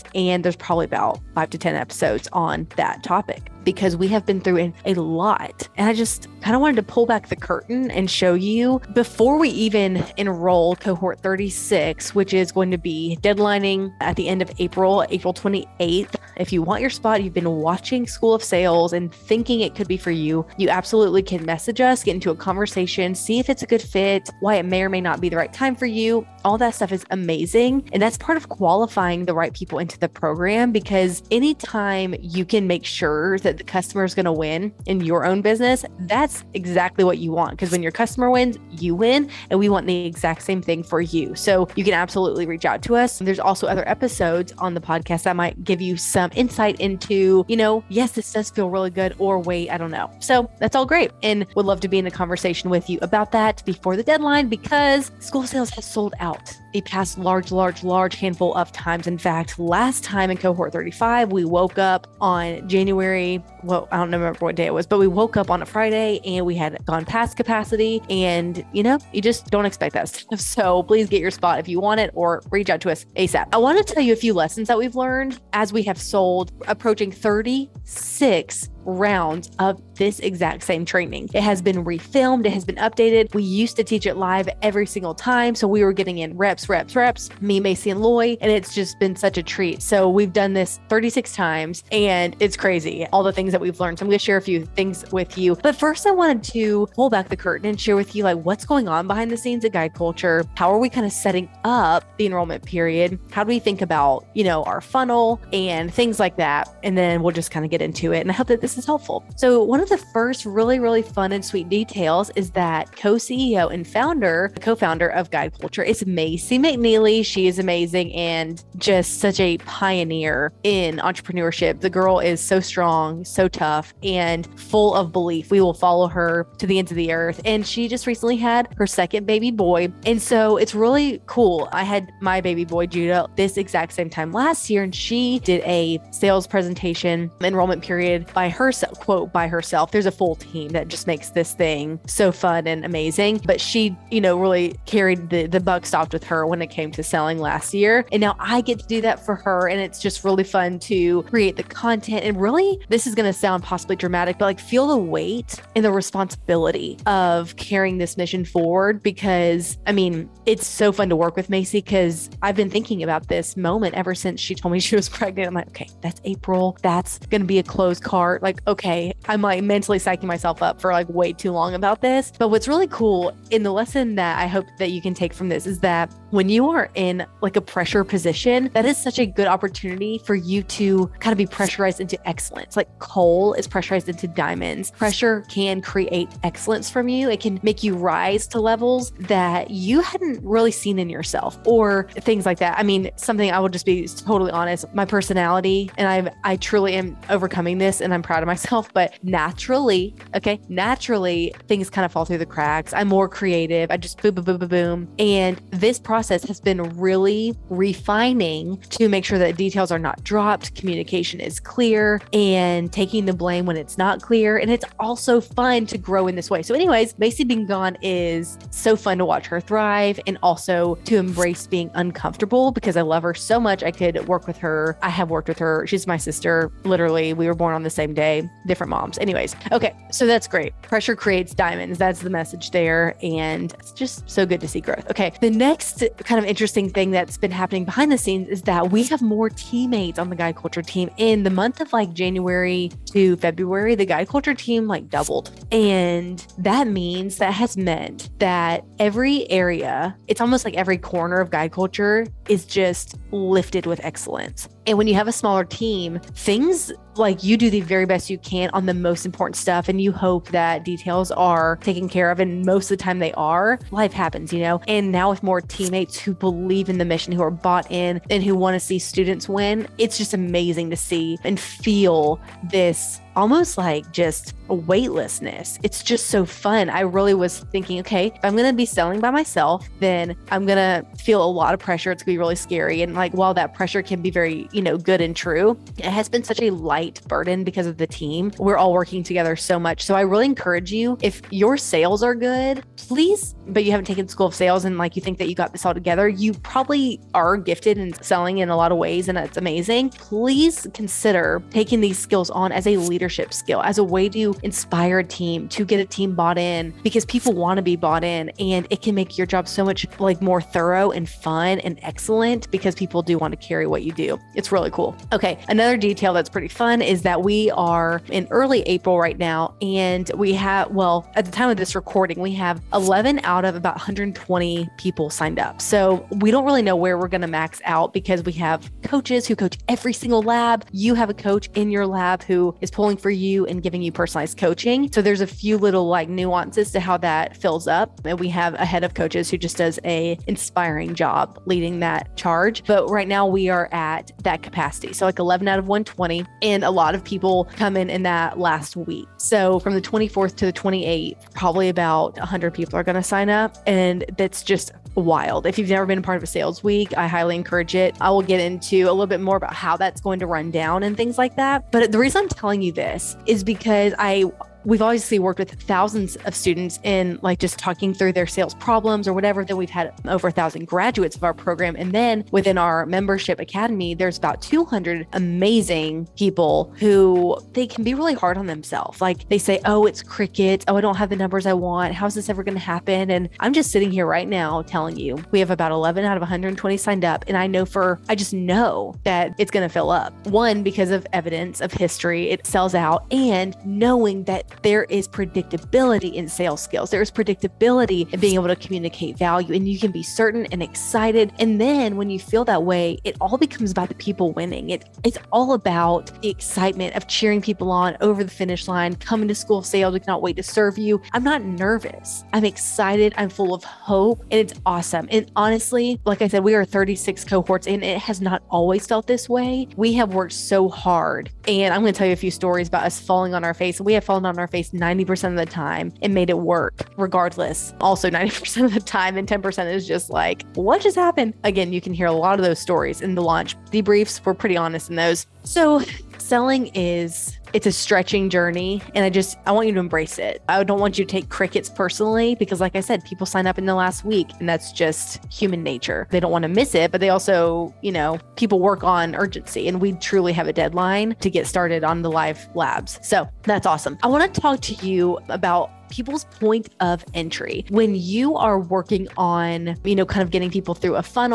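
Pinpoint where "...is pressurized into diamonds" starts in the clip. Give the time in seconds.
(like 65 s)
183 s.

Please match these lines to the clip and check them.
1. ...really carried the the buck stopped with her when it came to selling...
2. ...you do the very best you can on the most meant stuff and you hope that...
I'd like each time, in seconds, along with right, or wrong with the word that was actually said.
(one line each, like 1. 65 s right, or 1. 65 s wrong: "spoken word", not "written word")
1. 144 s right
2. 257 s wrong: "important", not "meant".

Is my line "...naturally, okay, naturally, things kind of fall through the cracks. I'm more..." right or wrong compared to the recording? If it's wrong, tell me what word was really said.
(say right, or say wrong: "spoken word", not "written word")
right.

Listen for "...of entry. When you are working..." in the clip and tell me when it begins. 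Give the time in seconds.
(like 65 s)
456 s.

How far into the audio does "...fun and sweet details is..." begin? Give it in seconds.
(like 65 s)
111 s.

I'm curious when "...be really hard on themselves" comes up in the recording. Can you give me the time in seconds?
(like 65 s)
378 s.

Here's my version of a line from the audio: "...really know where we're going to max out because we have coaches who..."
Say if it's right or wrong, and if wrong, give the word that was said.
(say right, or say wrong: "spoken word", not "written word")
right.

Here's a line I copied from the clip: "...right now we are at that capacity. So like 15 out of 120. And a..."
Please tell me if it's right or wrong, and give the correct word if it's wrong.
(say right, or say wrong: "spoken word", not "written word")
wrong: "11", not "15".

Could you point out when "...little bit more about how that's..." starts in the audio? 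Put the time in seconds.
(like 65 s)
359 s.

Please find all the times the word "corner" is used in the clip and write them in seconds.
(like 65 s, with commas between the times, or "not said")
250 s.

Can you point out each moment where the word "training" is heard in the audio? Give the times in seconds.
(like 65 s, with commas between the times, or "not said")
80 s.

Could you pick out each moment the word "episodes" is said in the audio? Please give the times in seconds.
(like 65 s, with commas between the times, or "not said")
1 s, 43 s.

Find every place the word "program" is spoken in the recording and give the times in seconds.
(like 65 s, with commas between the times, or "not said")
30 s, 371 s.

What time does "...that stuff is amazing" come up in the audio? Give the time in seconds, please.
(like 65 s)
26 s.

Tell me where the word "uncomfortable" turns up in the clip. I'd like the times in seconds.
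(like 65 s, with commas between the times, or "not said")
221 s.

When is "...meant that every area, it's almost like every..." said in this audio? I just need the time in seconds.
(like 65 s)
247 s.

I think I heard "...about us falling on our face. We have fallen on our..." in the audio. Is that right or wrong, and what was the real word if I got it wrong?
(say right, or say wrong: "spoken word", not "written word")
right.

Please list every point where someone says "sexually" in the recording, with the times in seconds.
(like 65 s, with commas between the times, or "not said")
not said.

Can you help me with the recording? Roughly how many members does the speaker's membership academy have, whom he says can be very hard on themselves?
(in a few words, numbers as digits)
200.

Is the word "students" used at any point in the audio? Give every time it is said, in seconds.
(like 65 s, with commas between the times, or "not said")
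268 s, 366 s.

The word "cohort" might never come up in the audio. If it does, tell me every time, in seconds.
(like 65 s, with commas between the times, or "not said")
10 s, 60 s, 417 s.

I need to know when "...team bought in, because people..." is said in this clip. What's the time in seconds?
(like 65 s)
306 s.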